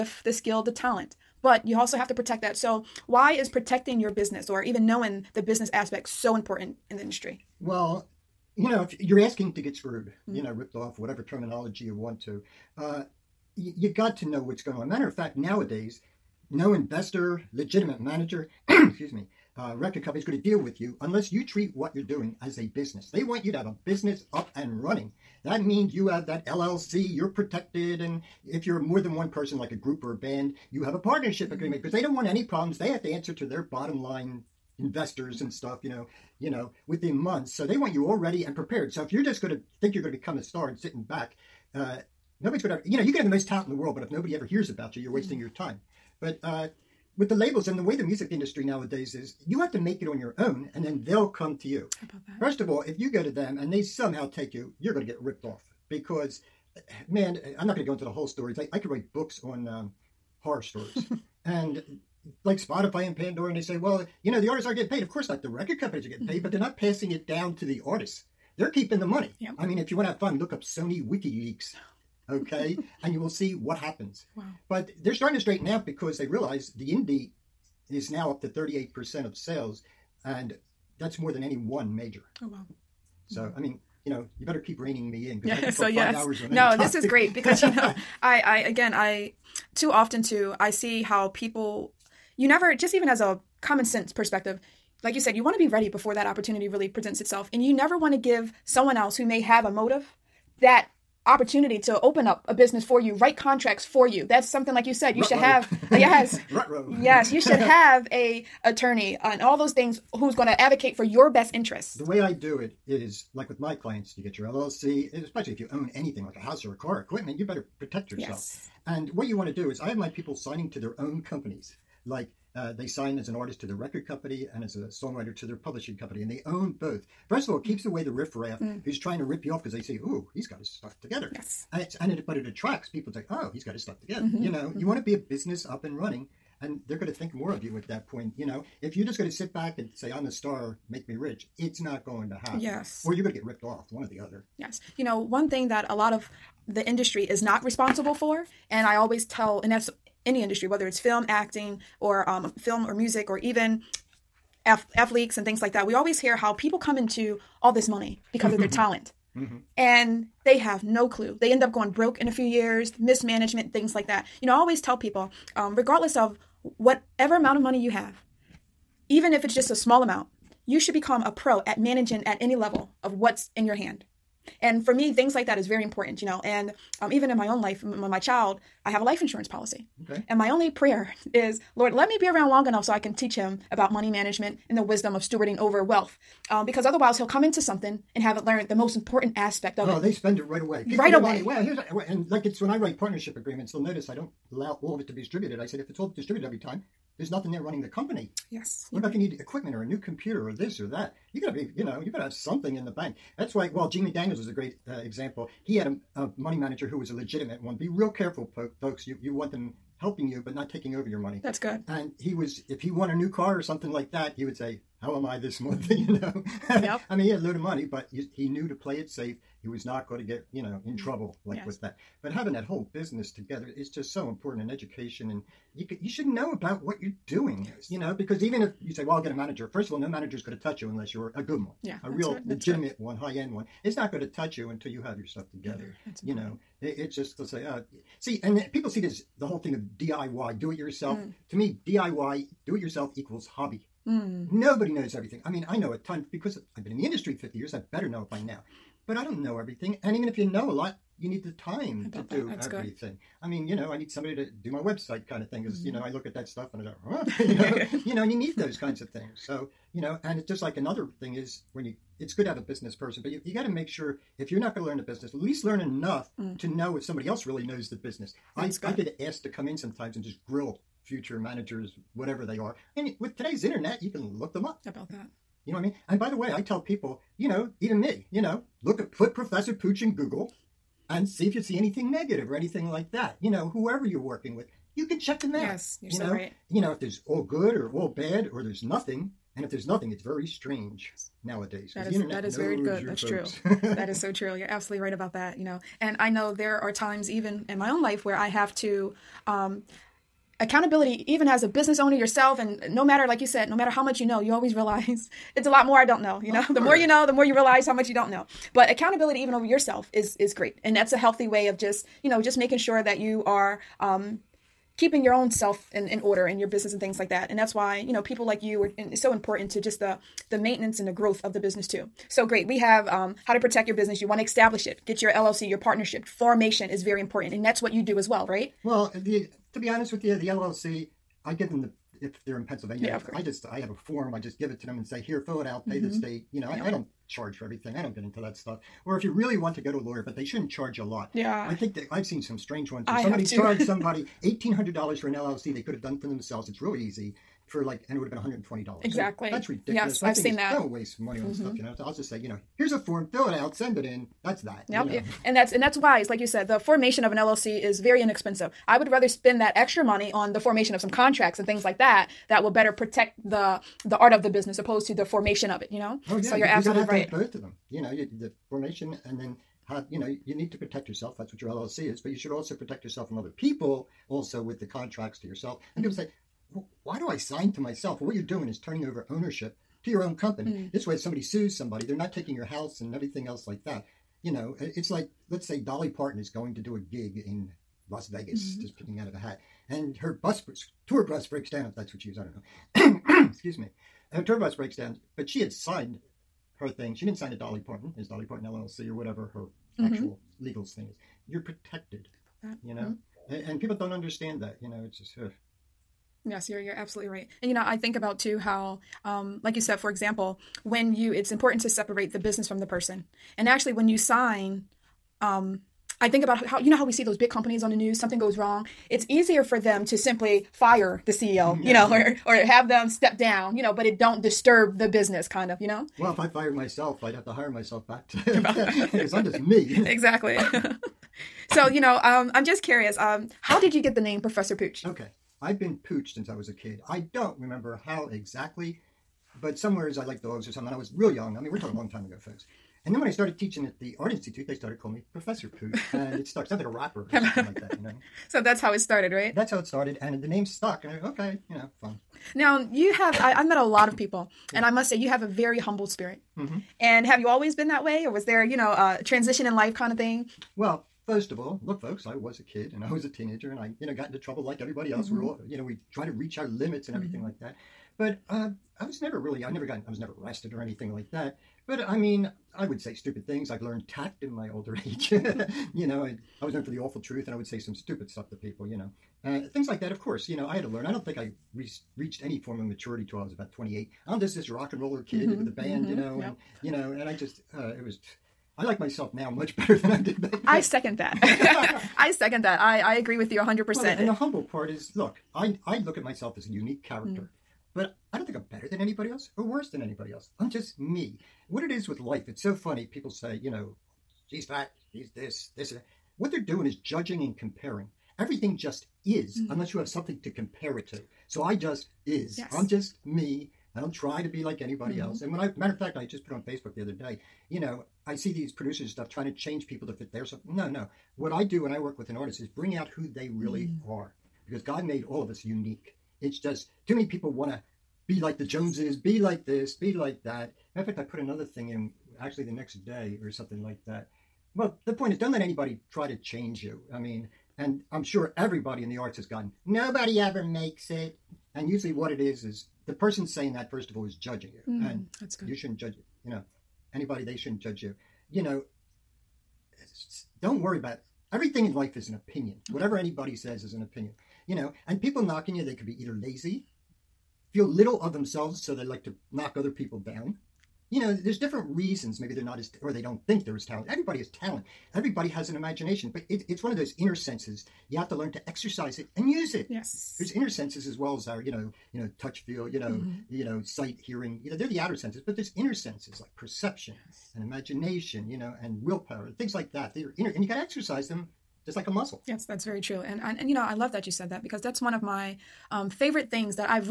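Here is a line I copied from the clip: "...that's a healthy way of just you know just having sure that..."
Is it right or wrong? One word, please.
wrong.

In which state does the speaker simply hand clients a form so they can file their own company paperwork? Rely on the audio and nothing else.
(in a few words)
Pennsylvania.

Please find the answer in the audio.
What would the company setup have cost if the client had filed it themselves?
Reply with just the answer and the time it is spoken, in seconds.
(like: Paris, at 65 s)
$120, at 348 s.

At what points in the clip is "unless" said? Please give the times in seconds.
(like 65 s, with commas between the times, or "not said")
21 s, 230 s, 509 s.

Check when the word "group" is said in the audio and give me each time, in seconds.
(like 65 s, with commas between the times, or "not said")
29 s.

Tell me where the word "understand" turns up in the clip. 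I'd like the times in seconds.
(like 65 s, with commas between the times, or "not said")
404 s.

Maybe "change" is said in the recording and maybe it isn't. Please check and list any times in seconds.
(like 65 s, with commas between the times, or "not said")
519 s, 536 s.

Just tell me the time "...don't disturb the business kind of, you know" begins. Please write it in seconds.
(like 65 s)
424 s.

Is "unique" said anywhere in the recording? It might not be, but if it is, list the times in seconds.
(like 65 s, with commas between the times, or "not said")
496 s, 525 s.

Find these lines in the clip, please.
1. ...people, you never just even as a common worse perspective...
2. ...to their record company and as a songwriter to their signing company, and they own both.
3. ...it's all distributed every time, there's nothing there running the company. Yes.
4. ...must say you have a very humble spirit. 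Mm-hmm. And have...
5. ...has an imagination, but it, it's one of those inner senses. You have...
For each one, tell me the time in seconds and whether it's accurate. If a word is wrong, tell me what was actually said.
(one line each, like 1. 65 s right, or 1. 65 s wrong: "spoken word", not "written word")
1. 91 s wrong: "sense", not "worse"
2. 123 s wrong: "publishing", not "signing"
3. 195 s right
4. 454 s right
5. 565 s right.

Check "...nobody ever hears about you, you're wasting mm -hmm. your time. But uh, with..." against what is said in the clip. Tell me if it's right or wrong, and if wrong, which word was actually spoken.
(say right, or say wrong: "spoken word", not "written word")
right.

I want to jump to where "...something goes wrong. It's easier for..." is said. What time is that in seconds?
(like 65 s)
418 s.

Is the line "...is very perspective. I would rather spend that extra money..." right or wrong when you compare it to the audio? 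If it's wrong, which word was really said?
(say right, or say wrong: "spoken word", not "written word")
wrong: "inexpensive", not "perspective".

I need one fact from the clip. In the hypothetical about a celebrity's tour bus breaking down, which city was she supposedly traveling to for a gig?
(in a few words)
Las Vegas.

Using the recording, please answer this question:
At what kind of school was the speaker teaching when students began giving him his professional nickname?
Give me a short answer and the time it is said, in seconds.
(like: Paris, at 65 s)
Art Institute, at 444 s.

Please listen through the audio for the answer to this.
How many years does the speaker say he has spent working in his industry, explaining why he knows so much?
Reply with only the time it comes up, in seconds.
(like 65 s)
247 s.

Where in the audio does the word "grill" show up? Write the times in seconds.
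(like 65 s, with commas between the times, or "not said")
270 s.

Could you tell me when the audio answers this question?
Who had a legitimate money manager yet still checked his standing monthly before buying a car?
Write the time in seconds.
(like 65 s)
203 s.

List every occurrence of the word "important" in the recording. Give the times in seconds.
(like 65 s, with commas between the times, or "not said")
6 s, 175 s, 188 s, 224 s, 319 s, 327 s, 411 s.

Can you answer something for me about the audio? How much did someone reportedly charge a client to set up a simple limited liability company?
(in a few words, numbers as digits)
$1,800.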